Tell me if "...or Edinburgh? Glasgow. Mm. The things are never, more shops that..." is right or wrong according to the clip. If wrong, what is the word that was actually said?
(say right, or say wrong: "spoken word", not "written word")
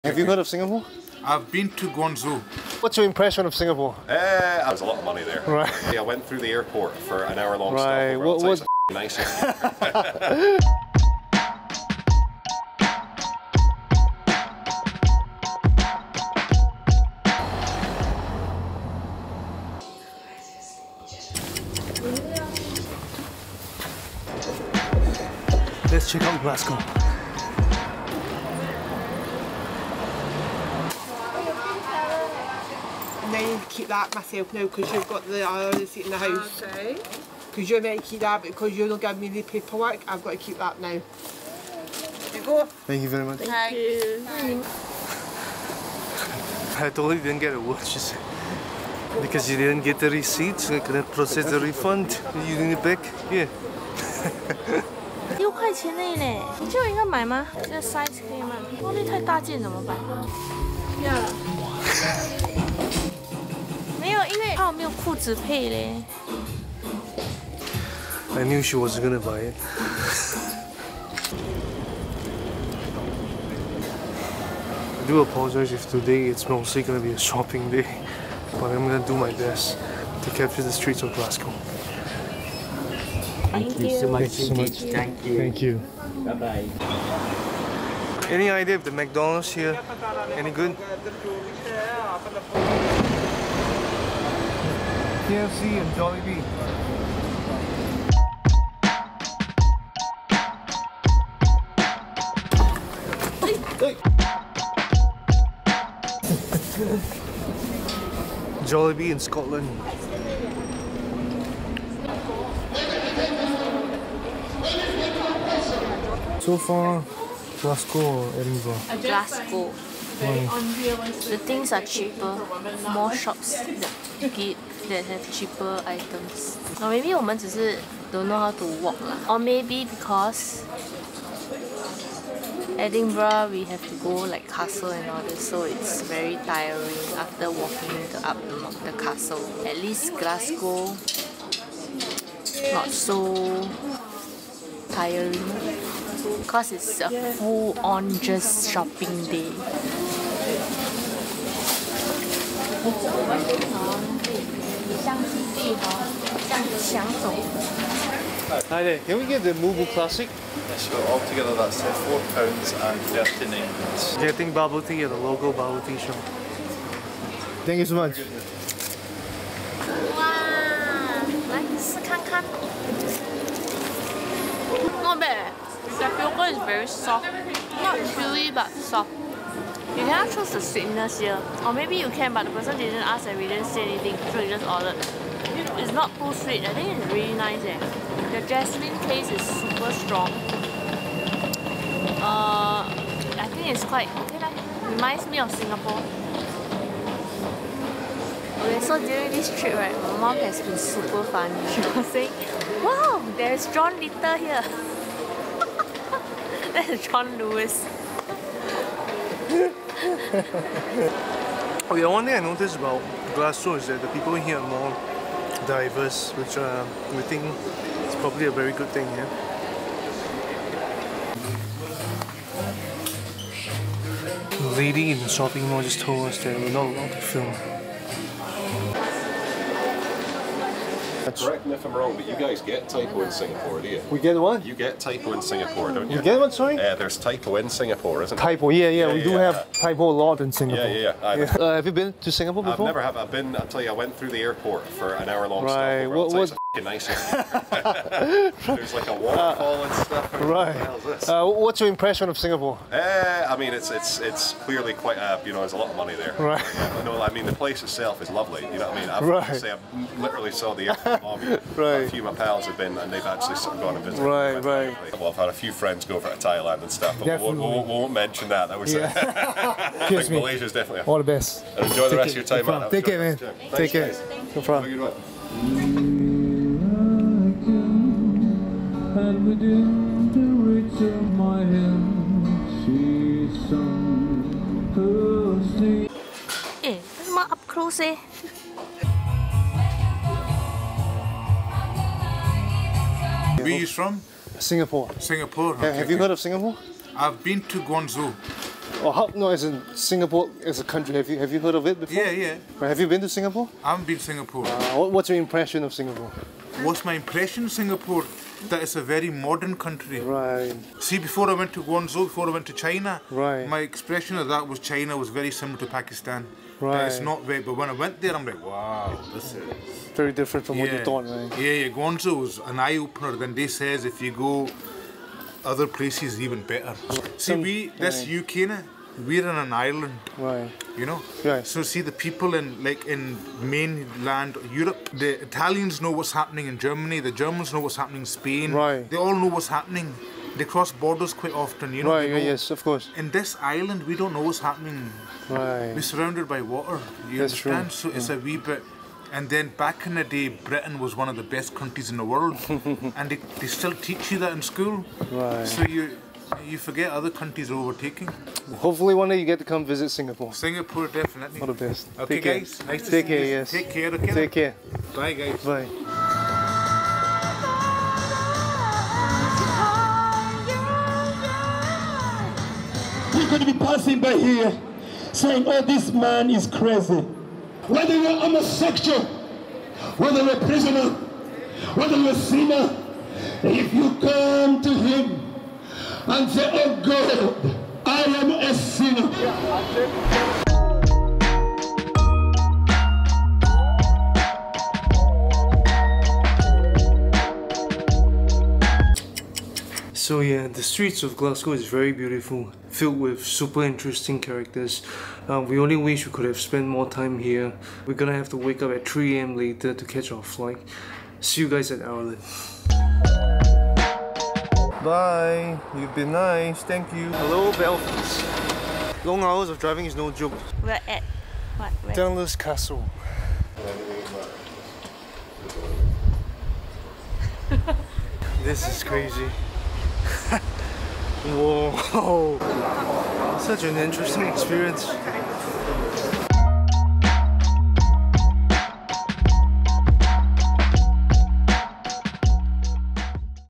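wrong: "cheaper", not "never".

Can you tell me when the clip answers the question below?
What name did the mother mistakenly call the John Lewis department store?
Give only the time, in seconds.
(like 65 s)
203 s.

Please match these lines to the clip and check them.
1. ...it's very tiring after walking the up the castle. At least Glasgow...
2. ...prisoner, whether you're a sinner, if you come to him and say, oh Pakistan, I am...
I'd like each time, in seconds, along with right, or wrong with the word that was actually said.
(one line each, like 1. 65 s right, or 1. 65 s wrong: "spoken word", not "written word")
1. 135 s right
2. 380 s wrong: "God", not "Pakistan".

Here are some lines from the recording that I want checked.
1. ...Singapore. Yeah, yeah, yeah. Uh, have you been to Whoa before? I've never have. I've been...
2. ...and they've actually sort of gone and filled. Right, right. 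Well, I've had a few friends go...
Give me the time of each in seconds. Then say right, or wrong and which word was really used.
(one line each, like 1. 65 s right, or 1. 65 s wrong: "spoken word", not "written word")
1. 240 s wrong: "Singapore", not "Whoa"
2. 262 s wrong: "visited", not "filled".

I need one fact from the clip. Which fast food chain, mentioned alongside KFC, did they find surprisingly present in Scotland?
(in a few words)
Jollibee.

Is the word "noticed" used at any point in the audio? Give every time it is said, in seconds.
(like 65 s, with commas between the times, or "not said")
212 s.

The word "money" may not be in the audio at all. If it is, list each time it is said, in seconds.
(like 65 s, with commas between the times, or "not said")
5 s, 255 s.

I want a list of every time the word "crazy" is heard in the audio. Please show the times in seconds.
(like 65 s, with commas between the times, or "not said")
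376 s, 429 s.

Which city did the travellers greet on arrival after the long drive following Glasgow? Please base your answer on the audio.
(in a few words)
Belfast.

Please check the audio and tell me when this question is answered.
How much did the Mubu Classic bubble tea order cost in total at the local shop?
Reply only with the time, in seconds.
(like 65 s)
161 s.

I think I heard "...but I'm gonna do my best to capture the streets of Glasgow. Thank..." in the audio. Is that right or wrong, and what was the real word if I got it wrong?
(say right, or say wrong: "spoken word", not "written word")
right.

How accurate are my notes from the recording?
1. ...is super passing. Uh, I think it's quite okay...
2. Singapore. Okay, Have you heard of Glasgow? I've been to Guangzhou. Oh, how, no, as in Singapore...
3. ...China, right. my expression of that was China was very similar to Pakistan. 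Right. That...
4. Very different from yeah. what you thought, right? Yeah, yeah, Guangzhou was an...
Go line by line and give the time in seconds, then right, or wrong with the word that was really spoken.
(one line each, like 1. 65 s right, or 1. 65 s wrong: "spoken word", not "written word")
1. 189 s wrong: "strong", not "passing"
2. 295 s wrong: "Singapore", not "Glasgow"
3. 312 s right
4. 320 s right.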